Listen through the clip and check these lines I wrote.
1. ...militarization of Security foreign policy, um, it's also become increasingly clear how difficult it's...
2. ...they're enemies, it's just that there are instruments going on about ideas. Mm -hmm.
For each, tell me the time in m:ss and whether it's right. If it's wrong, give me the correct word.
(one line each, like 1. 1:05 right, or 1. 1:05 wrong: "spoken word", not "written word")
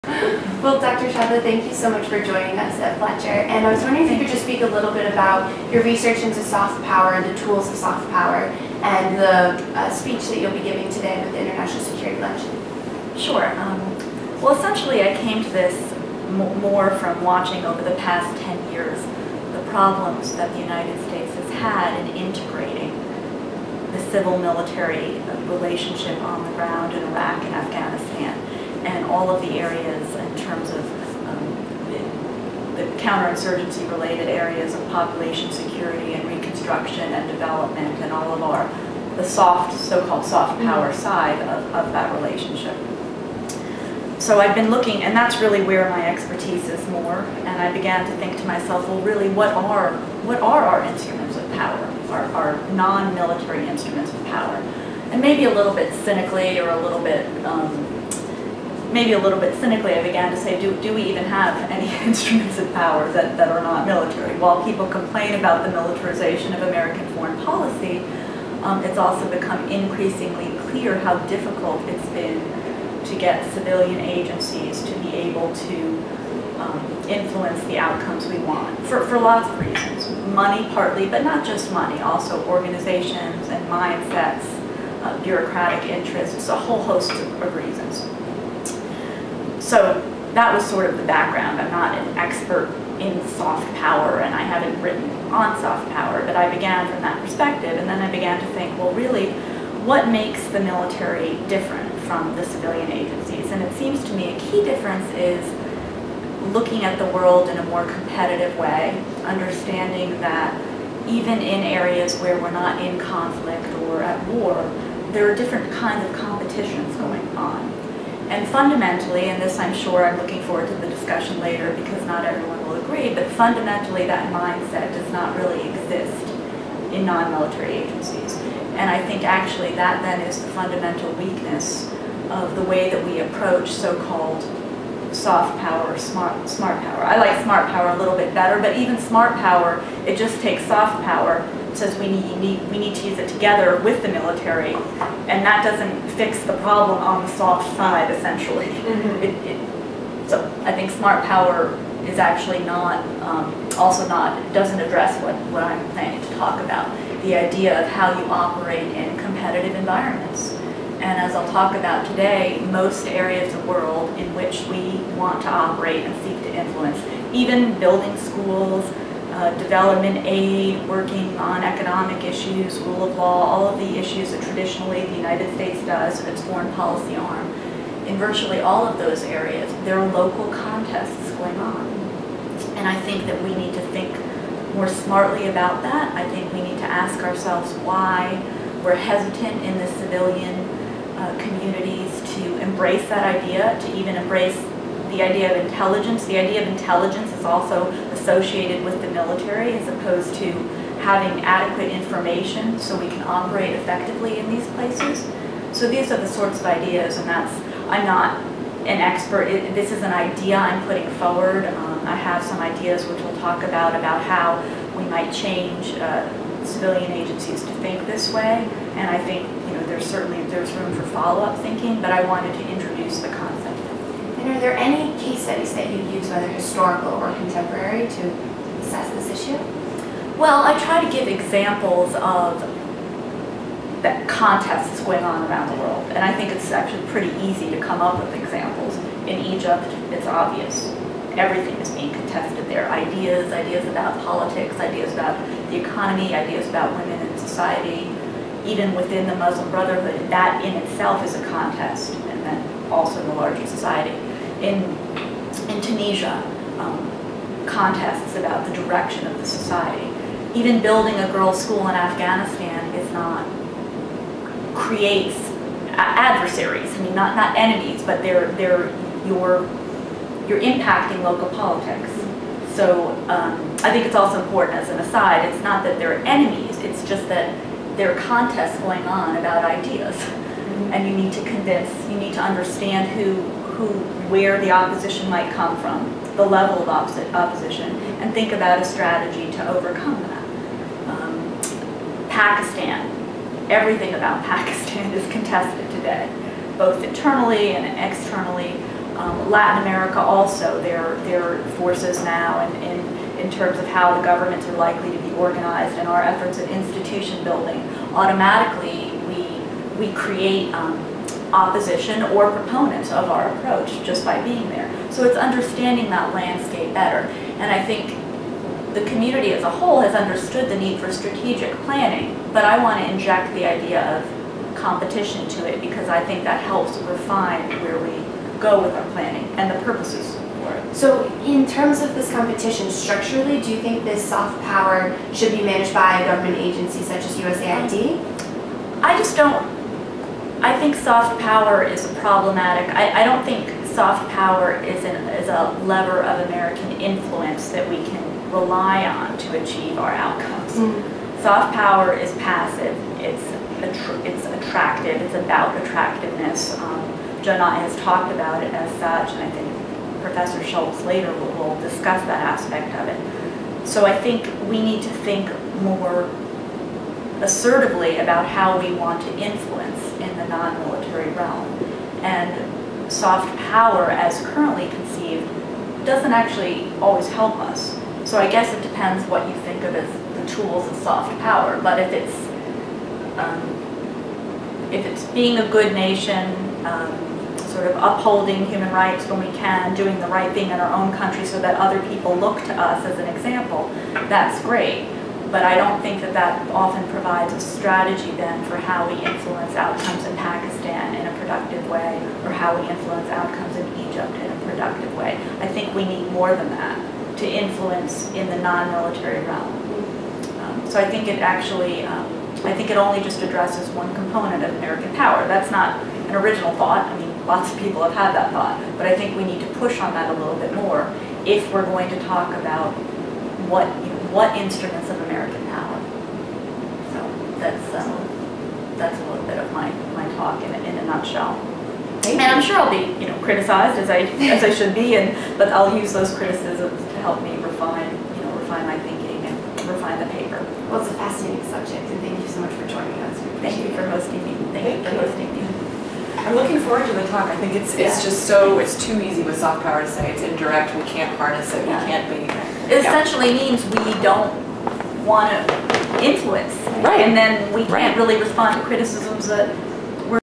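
1. 1:05 wrong: "American", not "Security"
2. 4:35 wrong: "contests", not "instruments".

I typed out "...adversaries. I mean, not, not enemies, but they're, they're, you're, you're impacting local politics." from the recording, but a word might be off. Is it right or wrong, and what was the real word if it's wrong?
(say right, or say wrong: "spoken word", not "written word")
right.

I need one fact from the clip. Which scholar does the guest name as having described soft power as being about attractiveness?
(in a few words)
Joe Nye.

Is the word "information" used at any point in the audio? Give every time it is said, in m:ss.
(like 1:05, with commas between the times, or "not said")
3:21.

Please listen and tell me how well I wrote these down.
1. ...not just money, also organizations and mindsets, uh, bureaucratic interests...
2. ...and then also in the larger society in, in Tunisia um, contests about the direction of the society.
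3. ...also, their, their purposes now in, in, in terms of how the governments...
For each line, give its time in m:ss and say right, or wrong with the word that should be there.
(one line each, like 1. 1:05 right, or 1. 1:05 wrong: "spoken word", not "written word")
1. 1:21 right
2. 4:12 right
3. 5:00 wrong: "forces", not "purposes".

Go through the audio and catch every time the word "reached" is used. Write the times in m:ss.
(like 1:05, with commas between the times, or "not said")
not said.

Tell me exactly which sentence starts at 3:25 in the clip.
So these are the sorts of ideas, and that's, I'm not an expert, it, this is an idea I'm putting forward.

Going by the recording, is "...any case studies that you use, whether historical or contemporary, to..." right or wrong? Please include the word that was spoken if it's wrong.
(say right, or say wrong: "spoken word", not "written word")
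right.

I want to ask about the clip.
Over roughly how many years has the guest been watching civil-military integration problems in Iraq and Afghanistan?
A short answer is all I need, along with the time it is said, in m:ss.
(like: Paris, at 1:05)
10, at 0:18.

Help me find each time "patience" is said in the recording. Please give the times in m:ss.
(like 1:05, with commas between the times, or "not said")
not said.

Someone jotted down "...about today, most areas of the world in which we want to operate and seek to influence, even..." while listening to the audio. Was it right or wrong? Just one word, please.
right.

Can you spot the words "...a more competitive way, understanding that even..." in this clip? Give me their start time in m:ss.
1:47.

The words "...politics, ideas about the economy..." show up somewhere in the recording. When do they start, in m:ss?
4:04.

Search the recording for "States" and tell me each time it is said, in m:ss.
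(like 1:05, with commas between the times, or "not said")
0:21, 2:55.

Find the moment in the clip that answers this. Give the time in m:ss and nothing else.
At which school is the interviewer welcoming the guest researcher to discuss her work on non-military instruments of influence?
0:02.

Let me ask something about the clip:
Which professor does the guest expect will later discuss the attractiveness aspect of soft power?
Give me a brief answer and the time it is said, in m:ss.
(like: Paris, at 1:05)
Professor Shultz, at 6:00.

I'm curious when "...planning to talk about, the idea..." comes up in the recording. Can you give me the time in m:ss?
2:35.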